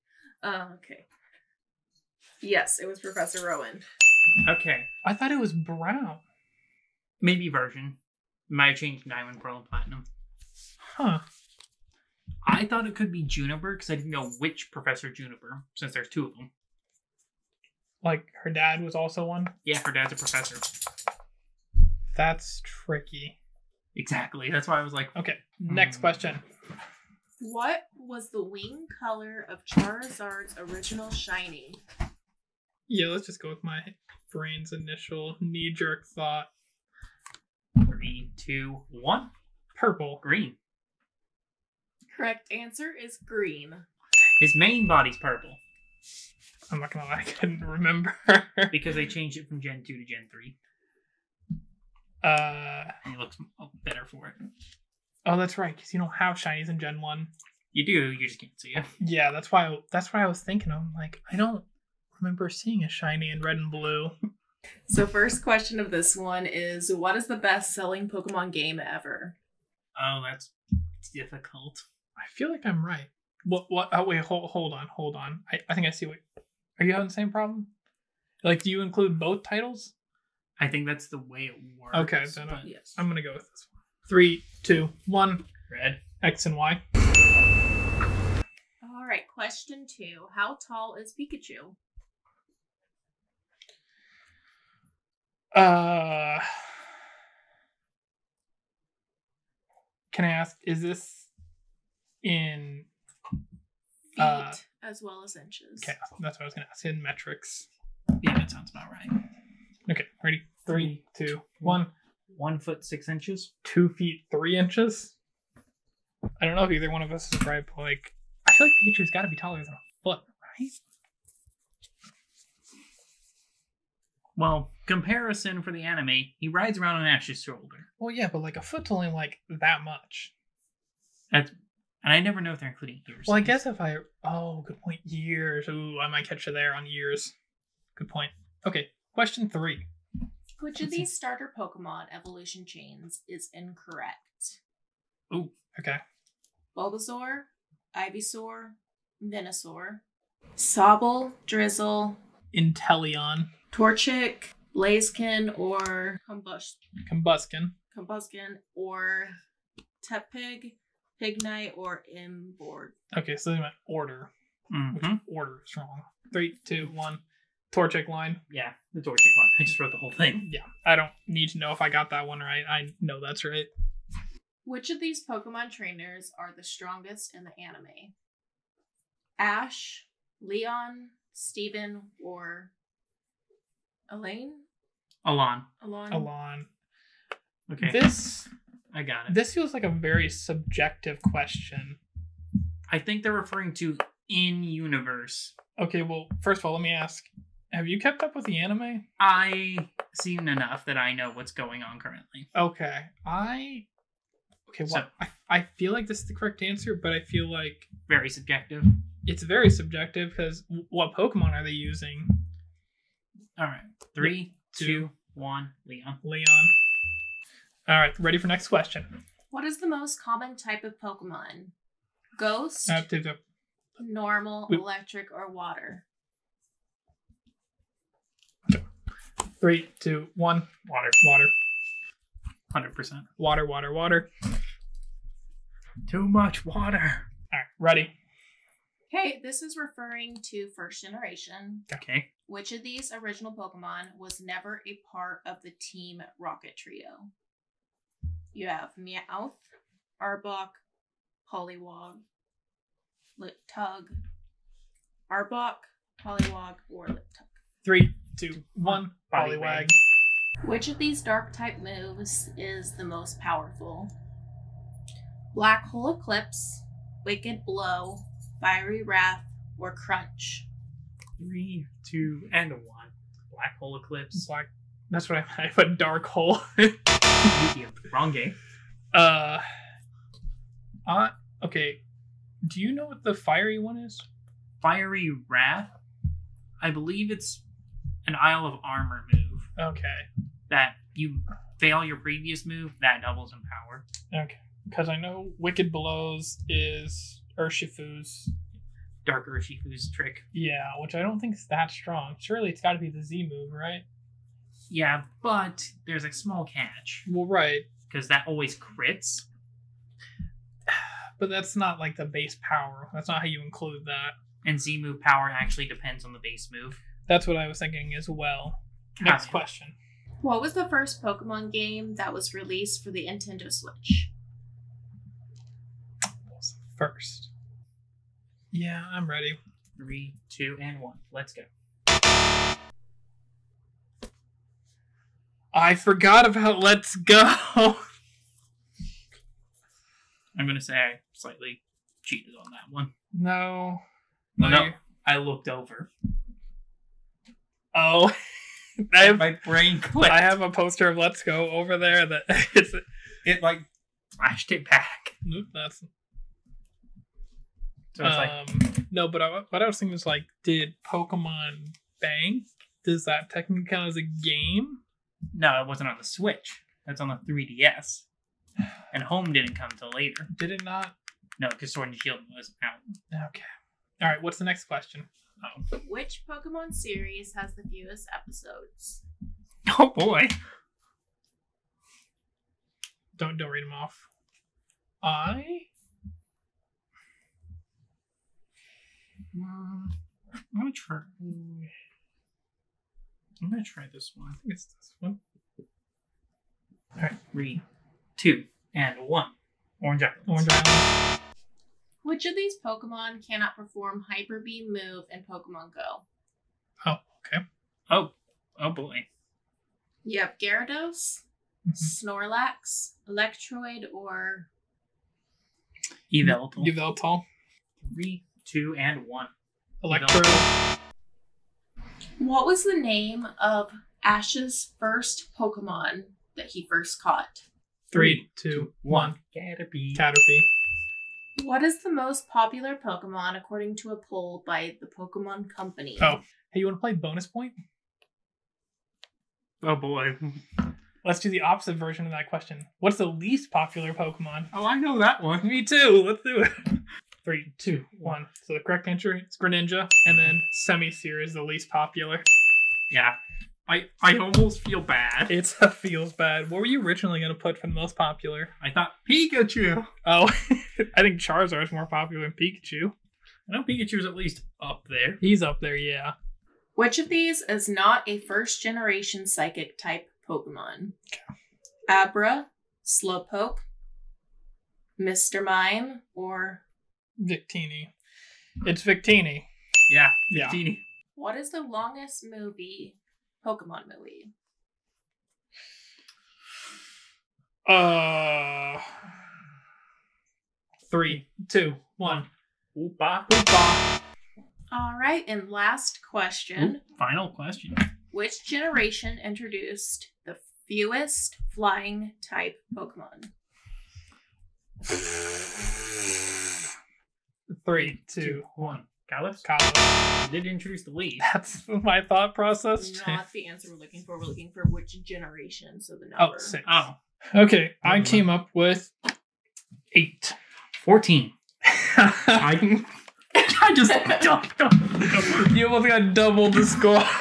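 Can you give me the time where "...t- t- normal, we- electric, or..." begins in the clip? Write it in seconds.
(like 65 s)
223 s.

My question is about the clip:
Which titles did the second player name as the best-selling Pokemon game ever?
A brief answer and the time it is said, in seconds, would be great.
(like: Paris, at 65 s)
X and Y, at 86 s.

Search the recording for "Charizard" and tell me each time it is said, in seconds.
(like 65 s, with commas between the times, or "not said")
29 s, 461 s.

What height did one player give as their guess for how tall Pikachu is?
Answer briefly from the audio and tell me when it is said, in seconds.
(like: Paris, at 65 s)
2 feet 3 inches, at 113 s.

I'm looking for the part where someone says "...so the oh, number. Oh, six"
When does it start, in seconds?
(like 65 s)
515 s.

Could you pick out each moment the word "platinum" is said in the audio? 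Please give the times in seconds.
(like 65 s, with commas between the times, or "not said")
9 s.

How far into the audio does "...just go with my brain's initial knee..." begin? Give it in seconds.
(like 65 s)
33 s.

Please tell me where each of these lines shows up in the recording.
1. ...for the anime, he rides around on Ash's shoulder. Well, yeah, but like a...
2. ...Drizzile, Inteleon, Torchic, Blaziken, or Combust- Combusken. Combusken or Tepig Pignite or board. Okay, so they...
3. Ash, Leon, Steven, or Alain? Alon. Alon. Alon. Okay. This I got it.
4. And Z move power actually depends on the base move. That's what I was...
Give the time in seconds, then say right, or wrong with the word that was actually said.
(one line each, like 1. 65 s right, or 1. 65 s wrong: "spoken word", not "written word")
1. 125 s right
2. 151 s right
3. 179 s right
4. 314 s right.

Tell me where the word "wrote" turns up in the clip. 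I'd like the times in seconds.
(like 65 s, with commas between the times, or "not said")
169 s.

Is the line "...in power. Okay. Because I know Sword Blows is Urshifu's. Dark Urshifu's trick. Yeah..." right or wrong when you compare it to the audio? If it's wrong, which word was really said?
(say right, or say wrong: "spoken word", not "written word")
wrong: "Wicked", not "Sword".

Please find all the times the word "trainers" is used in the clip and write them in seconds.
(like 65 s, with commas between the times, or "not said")
175 s.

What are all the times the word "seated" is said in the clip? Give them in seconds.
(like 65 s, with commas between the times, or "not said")
not said.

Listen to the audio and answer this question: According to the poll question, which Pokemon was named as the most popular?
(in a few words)
Greninja.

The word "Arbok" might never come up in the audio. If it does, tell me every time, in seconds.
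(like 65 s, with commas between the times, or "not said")
250 s, 255 s.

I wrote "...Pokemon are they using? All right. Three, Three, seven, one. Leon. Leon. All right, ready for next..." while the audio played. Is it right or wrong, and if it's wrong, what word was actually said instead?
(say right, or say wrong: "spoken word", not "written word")
wrong: "two", not "seven".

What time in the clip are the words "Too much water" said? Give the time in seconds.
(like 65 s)
236 s.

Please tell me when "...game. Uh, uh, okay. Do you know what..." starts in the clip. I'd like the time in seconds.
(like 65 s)
278 s.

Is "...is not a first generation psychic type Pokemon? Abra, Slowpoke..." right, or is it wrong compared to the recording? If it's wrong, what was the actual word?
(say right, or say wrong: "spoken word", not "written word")
right.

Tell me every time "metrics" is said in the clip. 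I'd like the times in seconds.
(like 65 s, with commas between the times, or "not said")
107 s.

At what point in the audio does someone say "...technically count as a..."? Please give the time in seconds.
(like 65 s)
363 s.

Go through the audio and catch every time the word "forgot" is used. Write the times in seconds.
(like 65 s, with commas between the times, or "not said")
335 s.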